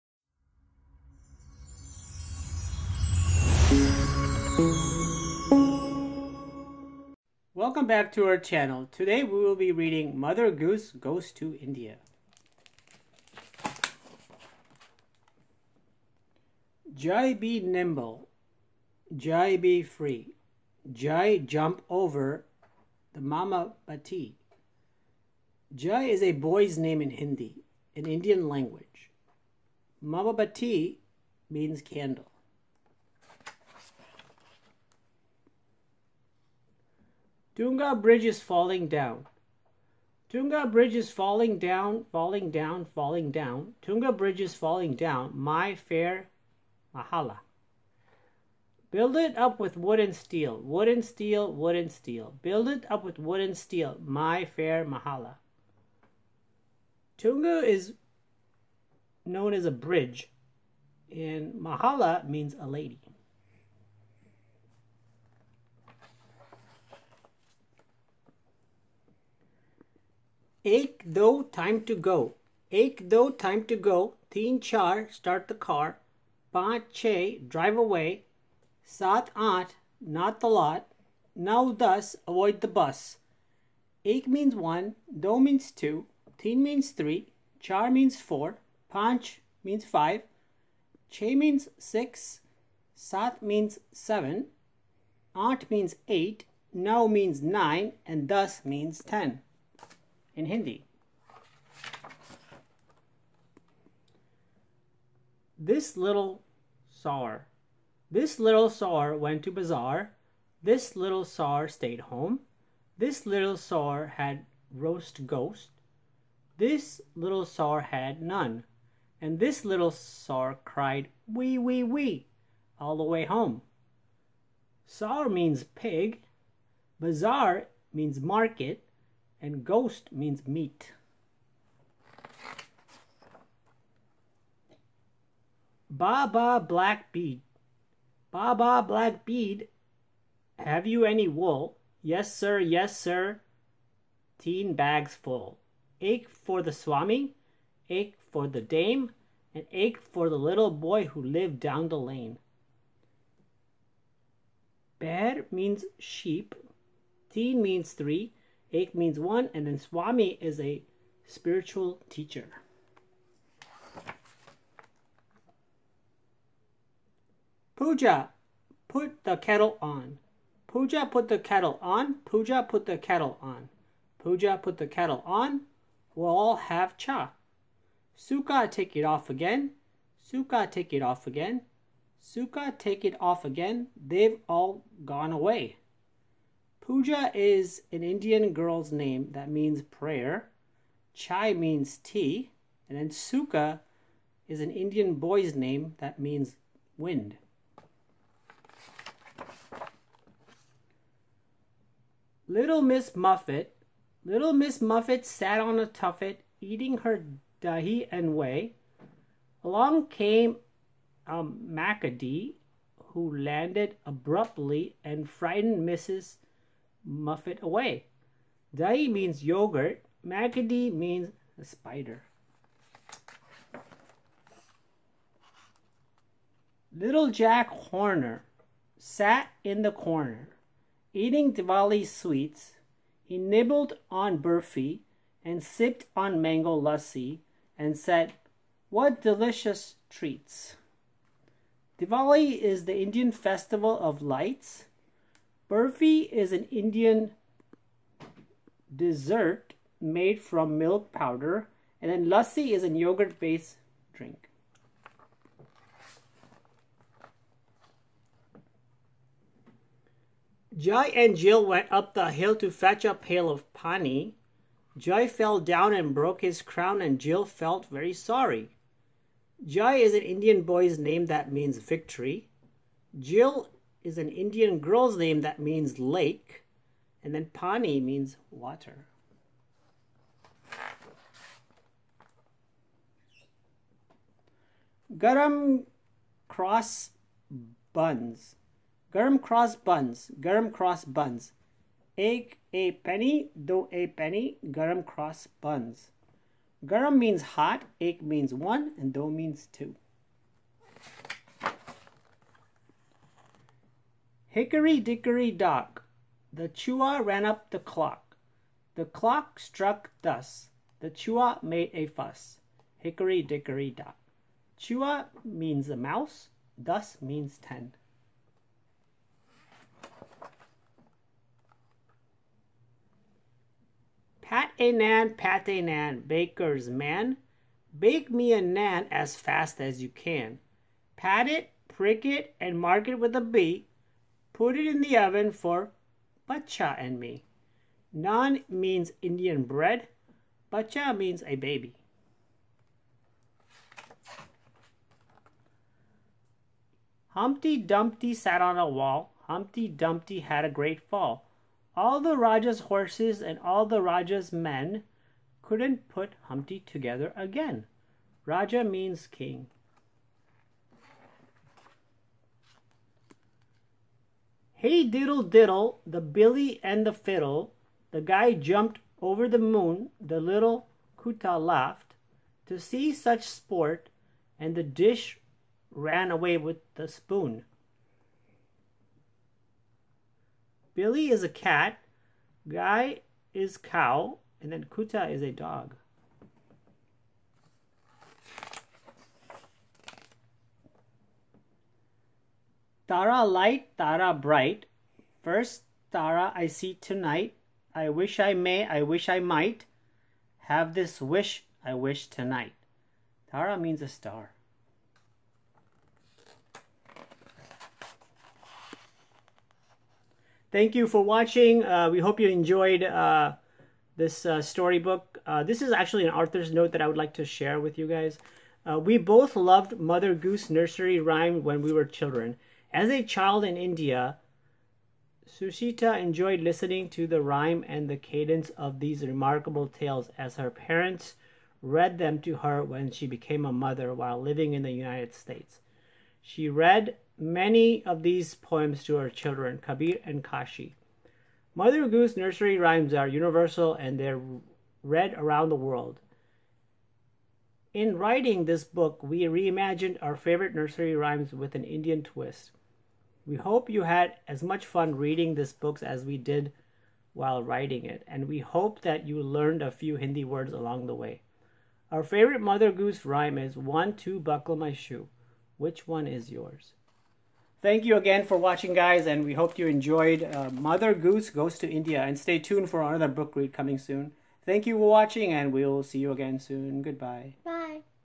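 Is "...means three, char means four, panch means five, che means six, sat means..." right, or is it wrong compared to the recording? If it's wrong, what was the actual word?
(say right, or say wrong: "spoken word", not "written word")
right.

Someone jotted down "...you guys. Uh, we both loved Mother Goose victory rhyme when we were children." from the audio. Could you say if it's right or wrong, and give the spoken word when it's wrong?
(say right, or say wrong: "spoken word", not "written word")
wrong: "nursery", not "victory".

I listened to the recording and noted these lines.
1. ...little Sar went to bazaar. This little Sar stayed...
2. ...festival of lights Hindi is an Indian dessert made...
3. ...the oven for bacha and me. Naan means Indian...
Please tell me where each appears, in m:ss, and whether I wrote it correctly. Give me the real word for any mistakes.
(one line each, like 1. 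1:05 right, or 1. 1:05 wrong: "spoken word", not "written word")
1. 1:48 right
2. 4:03 wrong: "Burfi", not "Hindi"
3. 5:35 right.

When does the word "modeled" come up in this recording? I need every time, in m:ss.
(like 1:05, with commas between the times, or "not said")
not said.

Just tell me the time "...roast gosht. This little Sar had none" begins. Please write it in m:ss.
1:54.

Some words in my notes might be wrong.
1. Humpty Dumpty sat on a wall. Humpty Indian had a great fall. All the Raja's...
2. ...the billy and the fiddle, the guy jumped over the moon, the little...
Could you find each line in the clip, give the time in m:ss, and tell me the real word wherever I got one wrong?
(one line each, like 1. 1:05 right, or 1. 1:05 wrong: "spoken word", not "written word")
1. 5:47 wrong: "Dumpty", not "Indian"
2. 6:06 right.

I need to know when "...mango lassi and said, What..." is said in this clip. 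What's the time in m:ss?
3:56.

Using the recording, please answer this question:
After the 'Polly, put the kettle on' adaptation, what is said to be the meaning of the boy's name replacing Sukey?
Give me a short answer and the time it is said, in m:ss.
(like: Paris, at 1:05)
wind, at 3:16.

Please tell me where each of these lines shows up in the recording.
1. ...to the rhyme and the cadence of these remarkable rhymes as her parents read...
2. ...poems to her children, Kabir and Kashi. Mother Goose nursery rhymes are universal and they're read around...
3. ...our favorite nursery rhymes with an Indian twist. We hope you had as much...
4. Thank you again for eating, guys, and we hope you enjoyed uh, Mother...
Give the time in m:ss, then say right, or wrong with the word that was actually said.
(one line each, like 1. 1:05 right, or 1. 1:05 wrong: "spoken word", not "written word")
1. 7:07 wrong: "tales", not "rhymes"
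2. 7:18 right
3. 7:30 right
4. 7:47 wrong: "watching", not "eating".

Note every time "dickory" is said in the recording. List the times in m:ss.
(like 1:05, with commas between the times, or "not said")
5:04, 5:13.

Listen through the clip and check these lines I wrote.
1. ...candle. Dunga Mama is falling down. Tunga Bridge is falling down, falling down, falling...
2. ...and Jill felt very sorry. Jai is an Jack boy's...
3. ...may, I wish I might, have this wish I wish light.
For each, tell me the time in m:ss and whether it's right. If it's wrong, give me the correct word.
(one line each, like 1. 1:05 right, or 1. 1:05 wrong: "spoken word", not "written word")
1. 0:31 wrong: "Bridge", not "Mama"
2. 4:27 wrong: "Indian", not "Jack"
3. 6:38 wrong: "tonight", not "light".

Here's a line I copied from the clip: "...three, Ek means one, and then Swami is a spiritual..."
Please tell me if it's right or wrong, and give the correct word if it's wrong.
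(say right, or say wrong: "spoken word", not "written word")
right.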